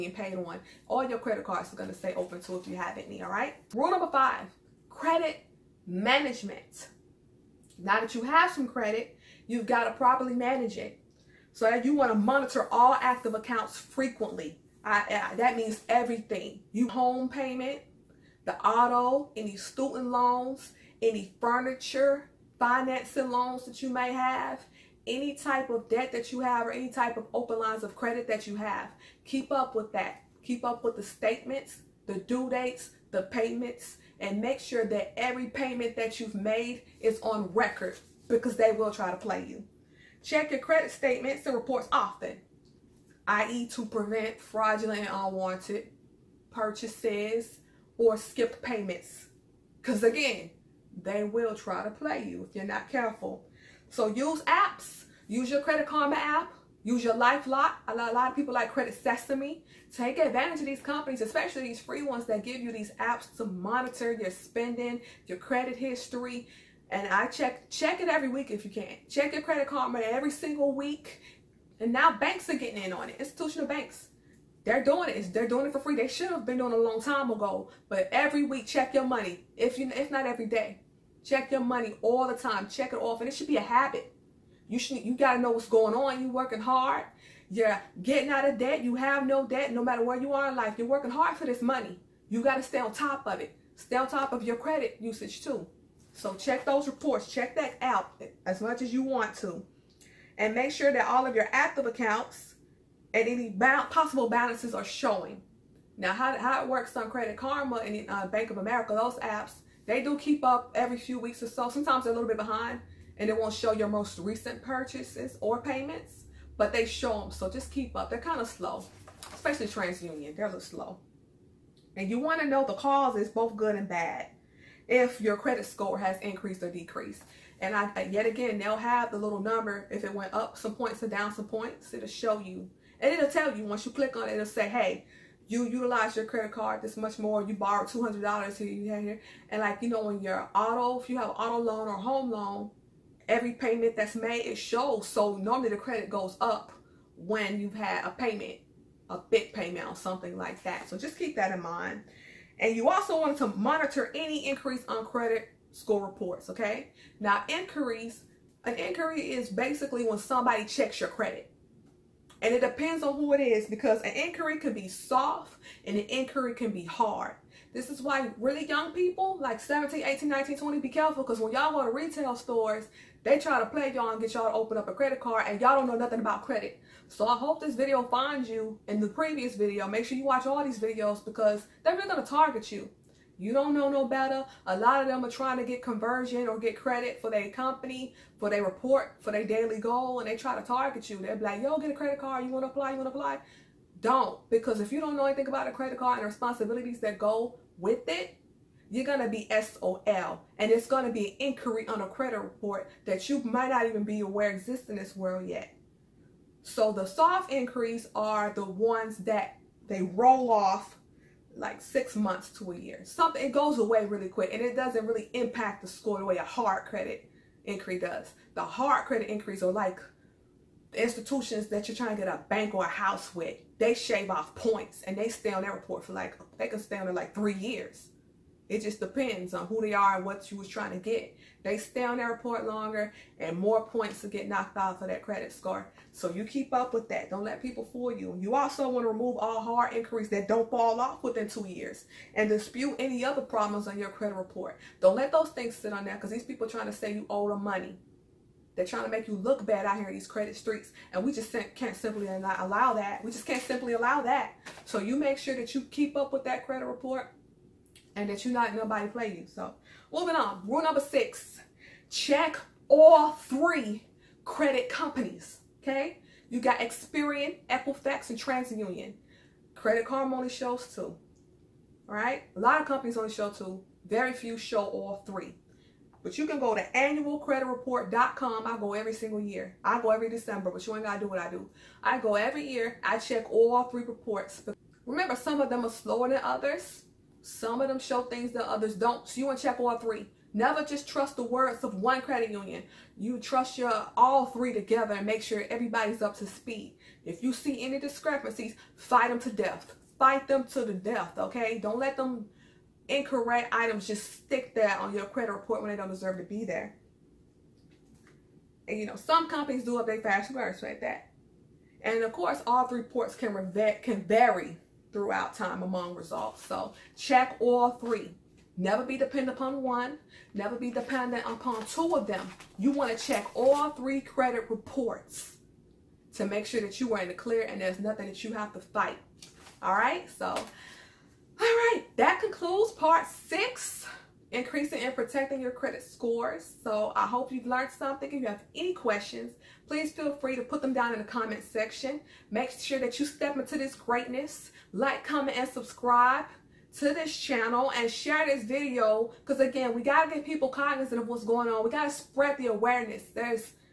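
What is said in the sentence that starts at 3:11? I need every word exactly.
They're like, yo, get a credit card.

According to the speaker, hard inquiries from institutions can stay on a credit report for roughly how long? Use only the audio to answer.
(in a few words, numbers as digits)
3 years.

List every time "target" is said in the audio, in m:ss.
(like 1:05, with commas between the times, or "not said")
3:02, 3:10.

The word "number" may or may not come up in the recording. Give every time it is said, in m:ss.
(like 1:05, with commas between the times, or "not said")
0:03, 2:09, 4:20.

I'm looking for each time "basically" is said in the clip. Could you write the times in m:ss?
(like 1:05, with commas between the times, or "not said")
2:39.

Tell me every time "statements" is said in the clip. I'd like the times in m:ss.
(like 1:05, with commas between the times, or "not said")
0:31, 0:40.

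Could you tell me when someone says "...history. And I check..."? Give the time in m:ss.
1:05.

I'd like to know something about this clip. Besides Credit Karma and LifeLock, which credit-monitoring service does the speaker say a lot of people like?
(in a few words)
Credit Sesame.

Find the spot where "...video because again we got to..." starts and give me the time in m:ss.
5:48.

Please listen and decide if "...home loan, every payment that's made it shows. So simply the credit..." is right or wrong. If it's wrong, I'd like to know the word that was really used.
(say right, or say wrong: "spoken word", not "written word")
wrong: "normally", not "simply".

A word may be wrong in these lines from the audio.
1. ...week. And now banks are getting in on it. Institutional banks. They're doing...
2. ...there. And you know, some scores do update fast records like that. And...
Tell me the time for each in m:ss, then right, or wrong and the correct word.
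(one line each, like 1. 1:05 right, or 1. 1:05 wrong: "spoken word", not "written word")
1. 1:10 right
2. 5:06 wrong: "companies", not "scores".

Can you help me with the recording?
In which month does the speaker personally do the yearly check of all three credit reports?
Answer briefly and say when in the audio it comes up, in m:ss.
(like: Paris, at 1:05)
December, at 4:40.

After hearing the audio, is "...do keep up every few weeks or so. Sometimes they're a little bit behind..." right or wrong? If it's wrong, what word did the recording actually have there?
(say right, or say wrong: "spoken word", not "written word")
right.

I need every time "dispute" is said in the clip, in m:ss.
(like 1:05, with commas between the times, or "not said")
4:02.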